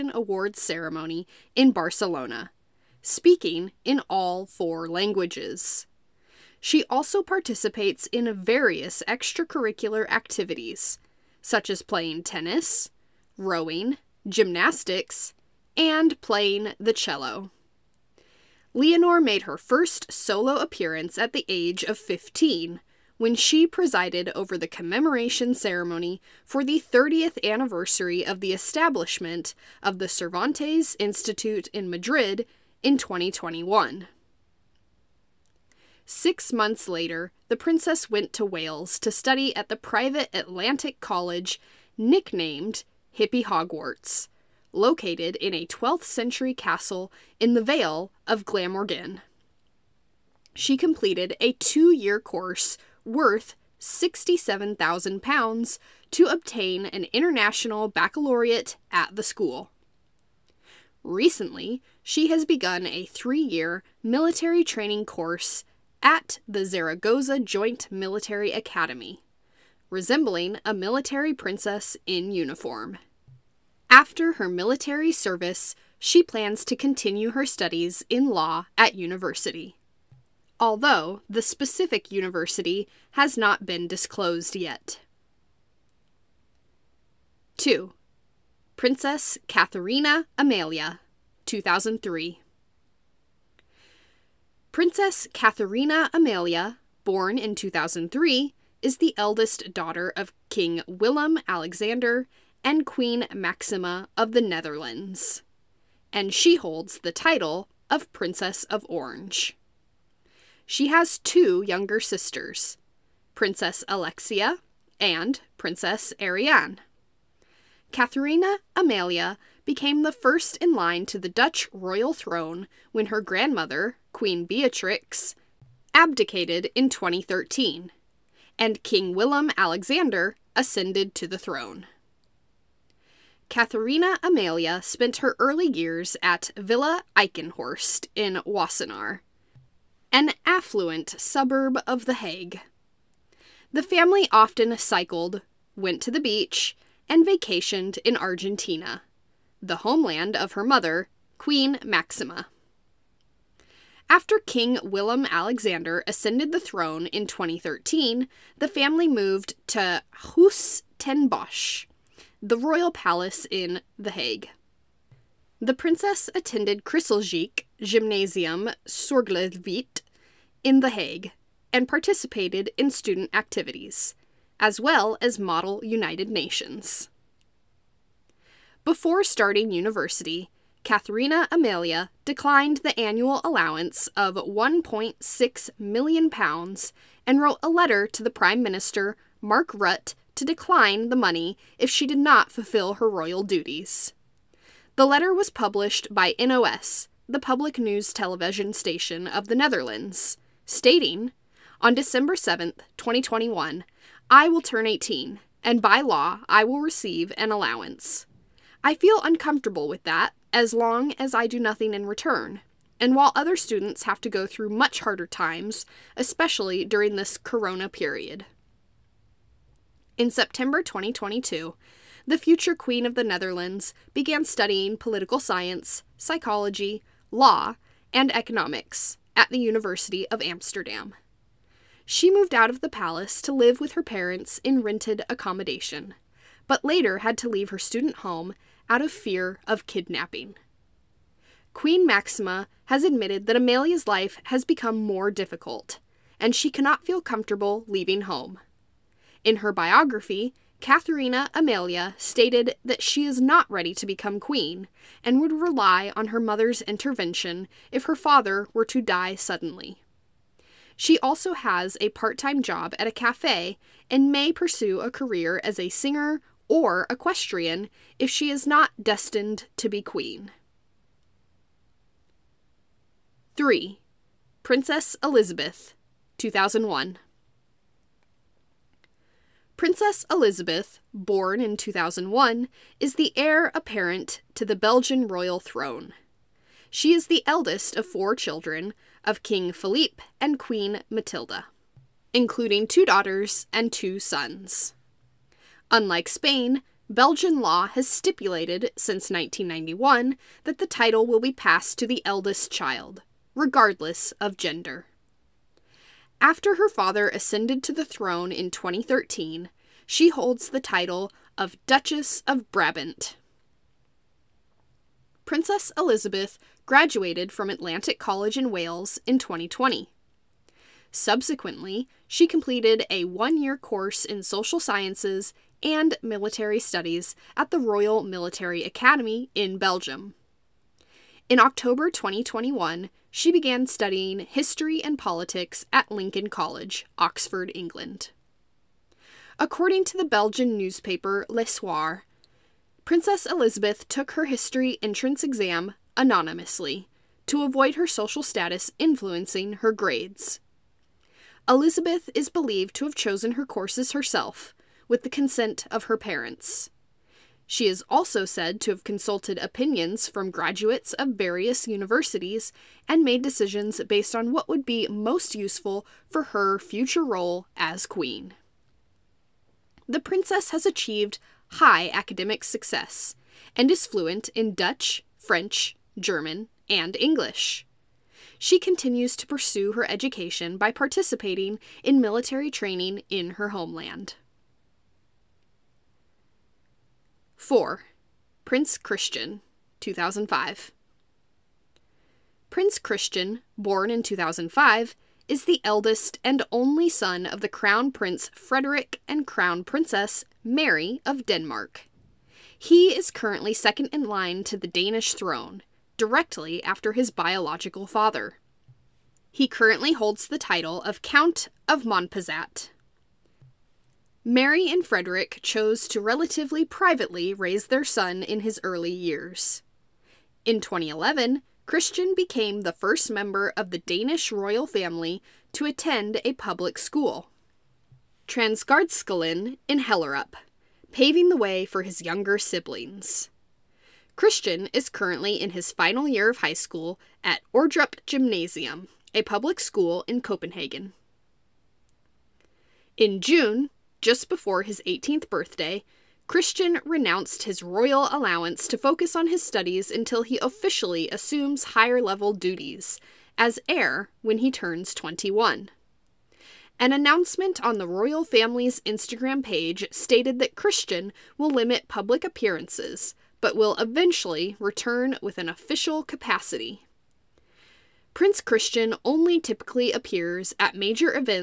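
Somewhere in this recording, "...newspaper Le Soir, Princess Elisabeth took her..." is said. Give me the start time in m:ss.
5:40.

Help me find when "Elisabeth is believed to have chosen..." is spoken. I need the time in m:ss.
5:51.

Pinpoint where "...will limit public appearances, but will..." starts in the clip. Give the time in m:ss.
7:41.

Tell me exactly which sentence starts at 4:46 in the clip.
She is the eldest of four children, of King Philippe and Queen Matilda, including two daughters and two sons.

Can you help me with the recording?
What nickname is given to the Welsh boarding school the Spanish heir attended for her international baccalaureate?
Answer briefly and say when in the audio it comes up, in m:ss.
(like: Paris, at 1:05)
Hippie Hogwarts, at 0:43.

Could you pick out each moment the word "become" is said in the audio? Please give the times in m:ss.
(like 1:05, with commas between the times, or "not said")
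4:04, 4:14.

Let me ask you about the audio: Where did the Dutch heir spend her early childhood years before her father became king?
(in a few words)
Villa Eichenhorst.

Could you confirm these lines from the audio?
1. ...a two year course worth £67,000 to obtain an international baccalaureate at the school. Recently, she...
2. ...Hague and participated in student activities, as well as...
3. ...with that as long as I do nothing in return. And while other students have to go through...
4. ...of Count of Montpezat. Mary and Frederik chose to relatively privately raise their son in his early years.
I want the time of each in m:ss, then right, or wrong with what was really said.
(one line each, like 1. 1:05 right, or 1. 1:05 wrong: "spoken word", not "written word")
1. 0:51 right
2. 2:50 right
3. 3:29 right
4. 6:51 right.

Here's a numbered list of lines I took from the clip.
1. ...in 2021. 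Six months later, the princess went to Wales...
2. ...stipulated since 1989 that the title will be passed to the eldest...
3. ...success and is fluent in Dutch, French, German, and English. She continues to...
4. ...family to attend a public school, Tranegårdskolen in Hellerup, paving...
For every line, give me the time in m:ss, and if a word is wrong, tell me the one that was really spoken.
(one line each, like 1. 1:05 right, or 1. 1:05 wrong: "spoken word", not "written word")
1. 0:32 right
2. 4:58 wrong: "1991", not "1989"
3. 6:12 right
4. 7:04 right.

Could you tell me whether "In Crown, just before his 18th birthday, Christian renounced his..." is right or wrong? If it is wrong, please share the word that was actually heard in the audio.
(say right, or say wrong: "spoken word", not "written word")
wrong: "June", not "Crown".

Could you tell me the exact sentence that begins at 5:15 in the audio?
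Princess Elisabeth graduated from Atlantic College in Wales in 2020.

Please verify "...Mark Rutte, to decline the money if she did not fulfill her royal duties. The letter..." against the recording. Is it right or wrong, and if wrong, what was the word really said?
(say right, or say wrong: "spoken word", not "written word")
right.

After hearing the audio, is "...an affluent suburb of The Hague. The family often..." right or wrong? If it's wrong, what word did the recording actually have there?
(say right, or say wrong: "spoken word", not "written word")
right.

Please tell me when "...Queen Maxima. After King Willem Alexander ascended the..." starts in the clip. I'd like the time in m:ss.
2:31.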